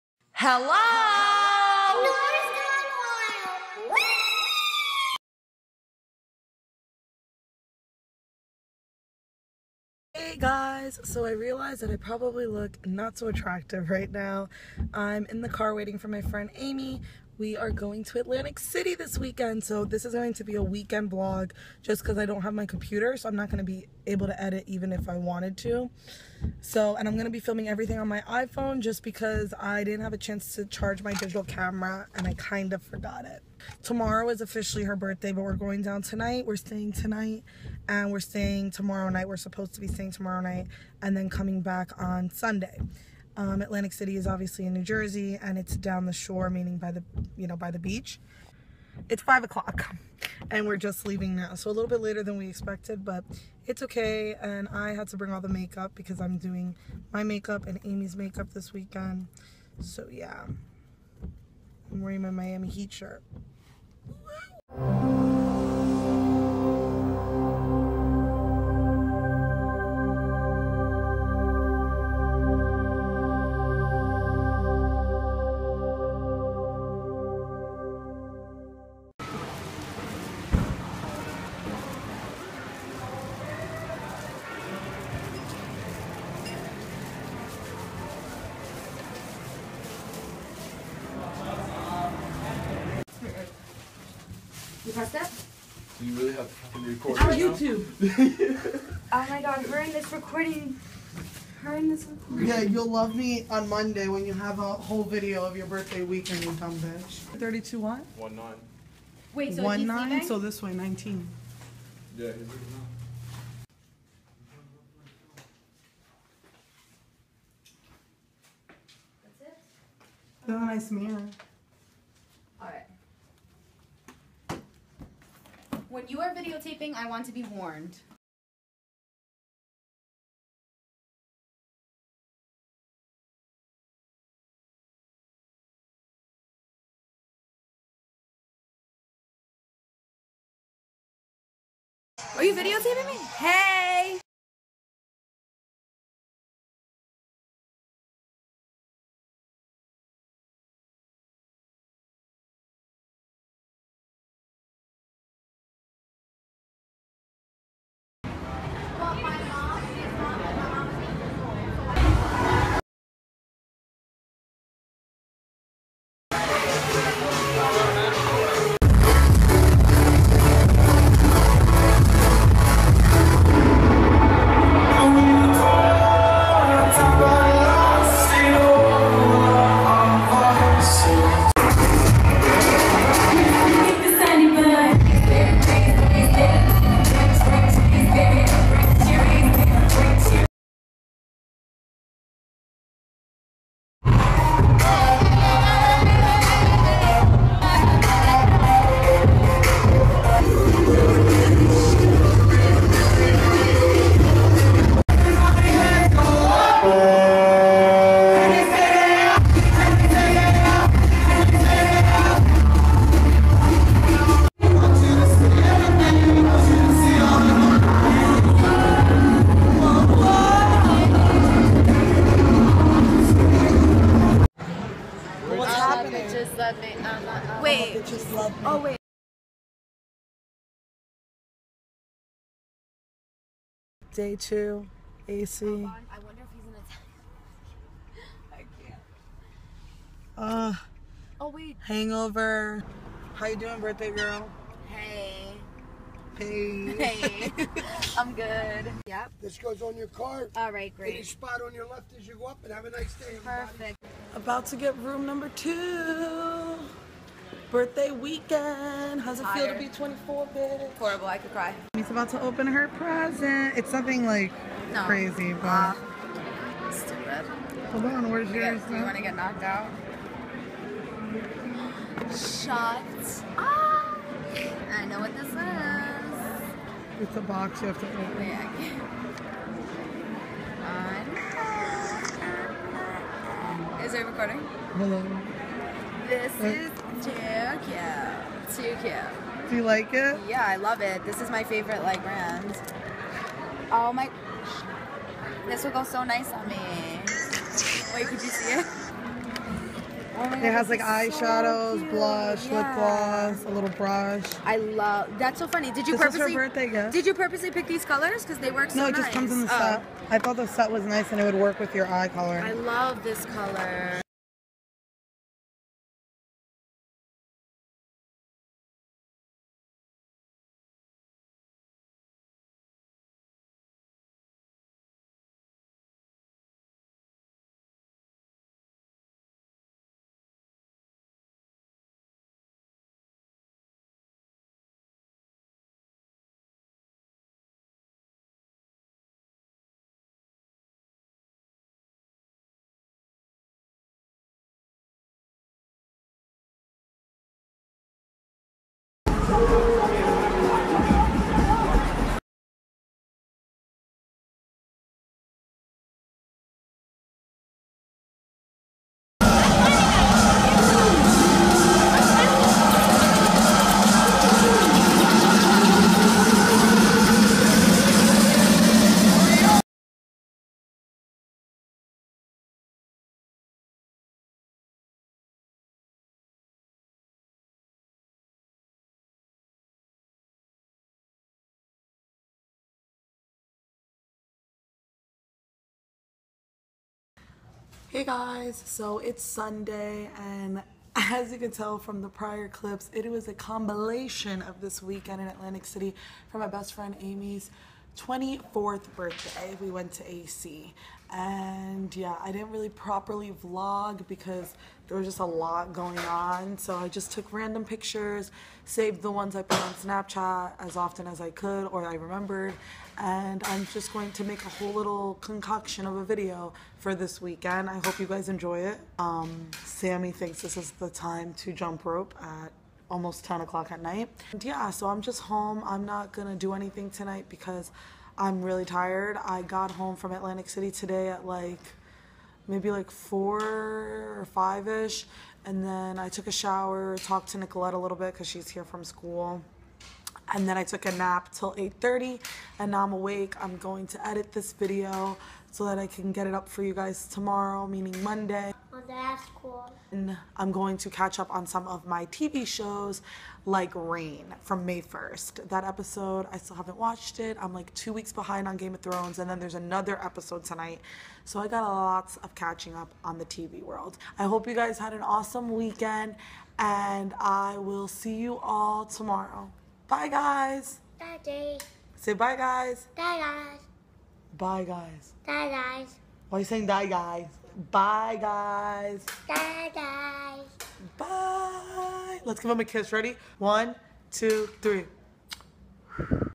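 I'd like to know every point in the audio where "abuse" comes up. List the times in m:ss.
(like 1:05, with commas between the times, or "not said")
not said.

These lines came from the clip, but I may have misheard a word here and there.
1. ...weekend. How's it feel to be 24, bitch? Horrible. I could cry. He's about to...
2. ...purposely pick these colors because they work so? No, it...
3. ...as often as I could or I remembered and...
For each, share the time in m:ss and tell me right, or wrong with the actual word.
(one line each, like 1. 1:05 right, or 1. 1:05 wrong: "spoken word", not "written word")
1. 4:18 right
2. 5:07 right
3. 6:50 right.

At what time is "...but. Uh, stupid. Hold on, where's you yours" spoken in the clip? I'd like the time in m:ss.
4:25.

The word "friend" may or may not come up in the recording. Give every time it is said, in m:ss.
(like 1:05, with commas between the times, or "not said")
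0:16, 6:36.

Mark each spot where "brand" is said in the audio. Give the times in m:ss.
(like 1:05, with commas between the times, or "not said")
4:52.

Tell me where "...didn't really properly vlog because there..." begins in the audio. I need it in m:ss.
6:42.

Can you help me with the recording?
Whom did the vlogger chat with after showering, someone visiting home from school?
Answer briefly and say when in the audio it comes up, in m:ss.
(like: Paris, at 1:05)
Nicolette, at 7:17.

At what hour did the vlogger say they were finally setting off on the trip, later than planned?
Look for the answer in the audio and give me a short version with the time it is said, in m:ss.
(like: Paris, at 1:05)
5 o'clock, at 0:49.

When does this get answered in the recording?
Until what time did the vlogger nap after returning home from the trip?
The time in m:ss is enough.
7:21.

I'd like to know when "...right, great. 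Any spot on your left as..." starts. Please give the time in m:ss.
4:10.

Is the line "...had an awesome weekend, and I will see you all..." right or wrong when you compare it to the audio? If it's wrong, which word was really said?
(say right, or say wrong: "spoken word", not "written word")
right.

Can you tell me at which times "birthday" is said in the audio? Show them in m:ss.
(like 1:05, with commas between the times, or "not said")
0:34, 1:45, 4:03, 4:17, 5:06, 6:39.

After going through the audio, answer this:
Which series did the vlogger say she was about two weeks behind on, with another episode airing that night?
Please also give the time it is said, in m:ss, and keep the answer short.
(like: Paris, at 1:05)
Game of Thrones, at 7:38.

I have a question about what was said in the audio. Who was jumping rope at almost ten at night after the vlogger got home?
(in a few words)
Sammy.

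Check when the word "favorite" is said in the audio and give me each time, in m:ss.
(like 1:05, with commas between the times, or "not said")
4:51.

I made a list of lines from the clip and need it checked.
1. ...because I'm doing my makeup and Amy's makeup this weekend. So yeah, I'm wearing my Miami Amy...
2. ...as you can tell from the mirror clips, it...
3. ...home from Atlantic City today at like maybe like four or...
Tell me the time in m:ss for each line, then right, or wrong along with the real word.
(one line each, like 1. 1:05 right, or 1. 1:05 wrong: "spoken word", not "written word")
1. 0:55 wrong: "Heat", not "Amy"
2. 6:31 wrong: "prior", not "mirror"
3. 7:09 right.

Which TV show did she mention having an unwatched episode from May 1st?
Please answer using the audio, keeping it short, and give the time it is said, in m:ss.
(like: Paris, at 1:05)
Reign, at 7:33.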